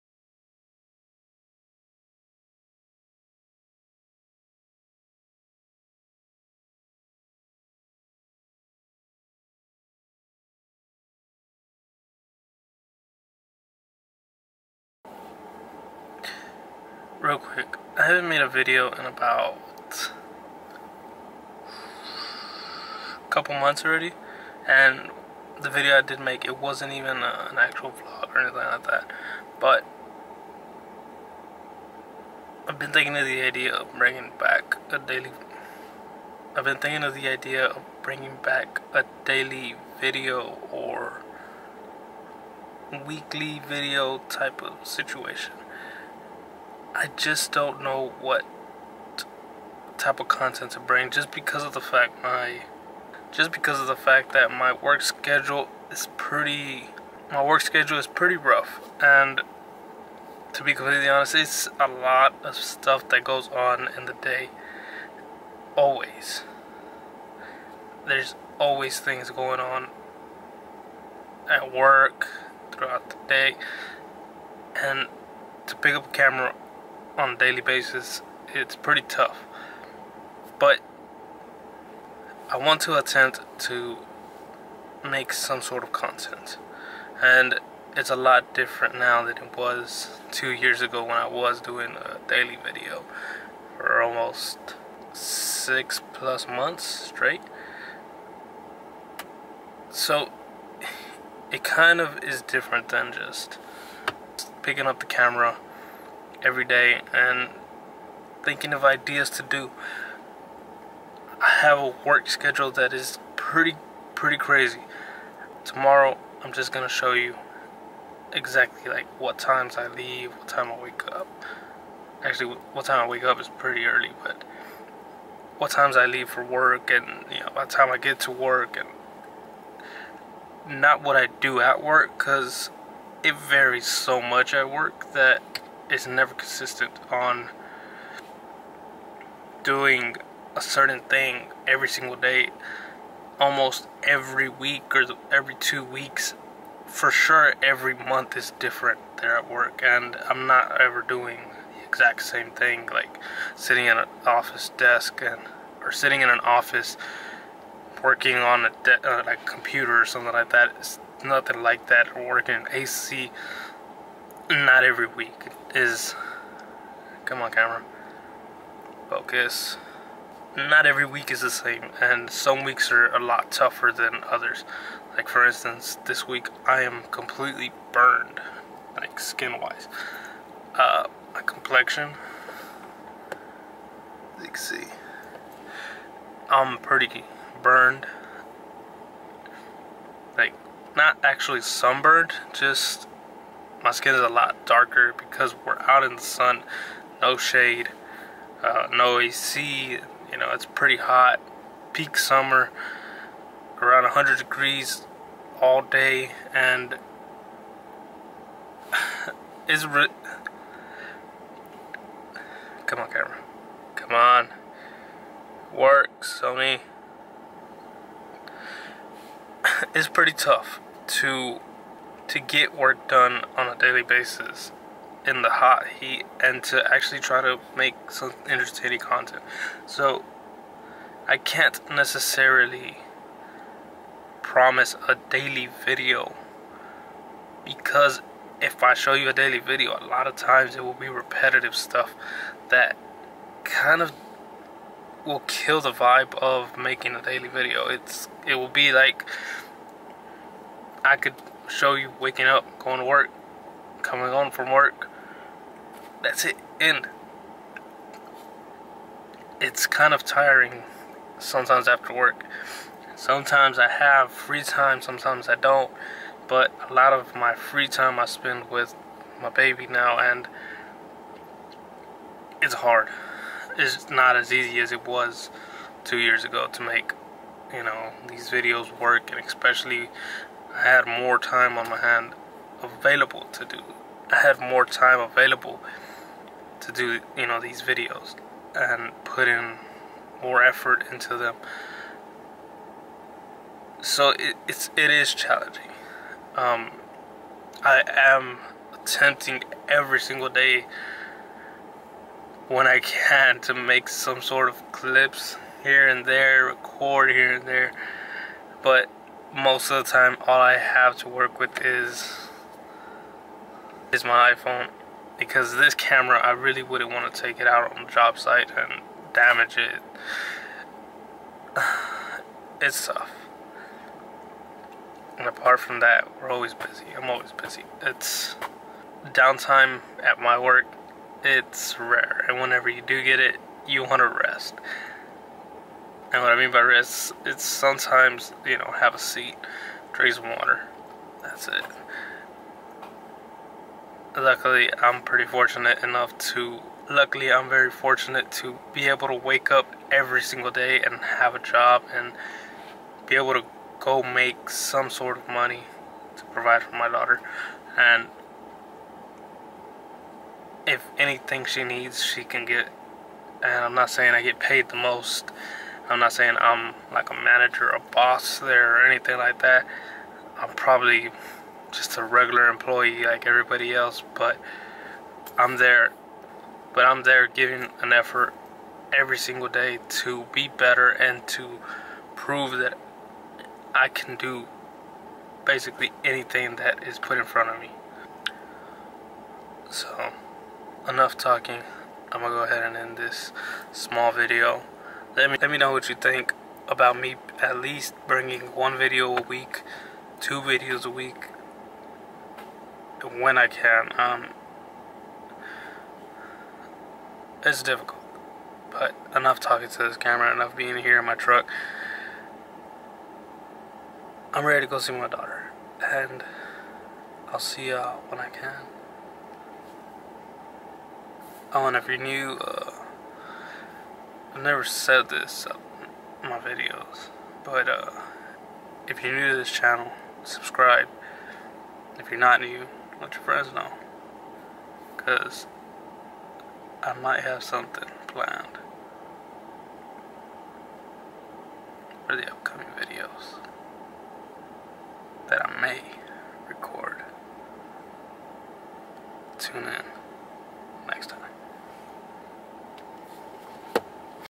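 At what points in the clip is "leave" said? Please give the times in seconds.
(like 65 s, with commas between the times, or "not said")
119 s, 126 s.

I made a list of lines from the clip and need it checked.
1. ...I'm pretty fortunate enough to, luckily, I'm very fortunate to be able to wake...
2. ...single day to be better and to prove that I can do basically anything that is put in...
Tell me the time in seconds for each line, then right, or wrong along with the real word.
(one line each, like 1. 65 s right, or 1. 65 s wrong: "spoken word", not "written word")
1. 345 s right
2. 379 s right.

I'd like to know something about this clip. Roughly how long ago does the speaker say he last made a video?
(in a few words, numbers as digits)
a couple months.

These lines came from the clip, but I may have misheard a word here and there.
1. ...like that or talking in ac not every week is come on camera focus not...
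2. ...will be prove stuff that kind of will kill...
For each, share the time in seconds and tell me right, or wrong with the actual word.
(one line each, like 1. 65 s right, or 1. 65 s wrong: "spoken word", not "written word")
1. 161 s wrong: "working", not "talking"
2. 240 s wrong: "repetitive", not "prove".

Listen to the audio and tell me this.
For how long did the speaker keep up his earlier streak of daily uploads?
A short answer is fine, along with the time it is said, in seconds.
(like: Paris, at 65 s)
6 plus months, at 95 s.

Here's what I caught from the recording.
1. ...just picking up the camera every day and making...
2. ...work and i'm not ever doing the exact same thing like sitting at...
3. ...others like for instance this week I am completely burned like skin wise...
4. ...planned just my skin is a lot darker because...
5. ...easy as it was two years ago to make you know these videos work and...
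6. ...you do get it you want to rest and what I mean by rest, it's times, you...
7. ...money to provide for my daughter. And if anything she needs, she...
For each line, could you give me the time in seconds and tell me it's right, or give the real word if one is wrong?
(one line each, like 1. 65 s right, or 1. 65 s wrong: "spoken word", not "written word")
1. 103 s wrong: "thinking", not "making"
2. 149 s right
3. 174 s right
4. 191 s wrong: "sunburned", not "planned"
5. 274 s right
6. 332 s wrong: "sometimes", not "times"
7. 355 s right.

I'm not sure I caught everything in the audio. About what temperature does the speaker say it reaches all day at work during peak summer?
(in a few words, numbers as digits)
100 degrees.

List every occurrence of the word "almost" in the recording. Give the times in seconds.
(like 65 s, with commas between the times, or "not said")
94 s, 143 s.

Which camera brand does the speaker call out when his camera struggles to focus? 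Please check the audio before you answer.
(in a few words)
Sony.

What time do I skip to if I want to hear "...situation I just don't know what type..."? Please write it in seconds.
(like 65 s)
44 s.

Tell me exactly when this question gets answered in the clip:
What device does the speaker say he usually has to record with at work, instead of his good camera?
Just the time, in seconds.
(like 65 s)
314 s.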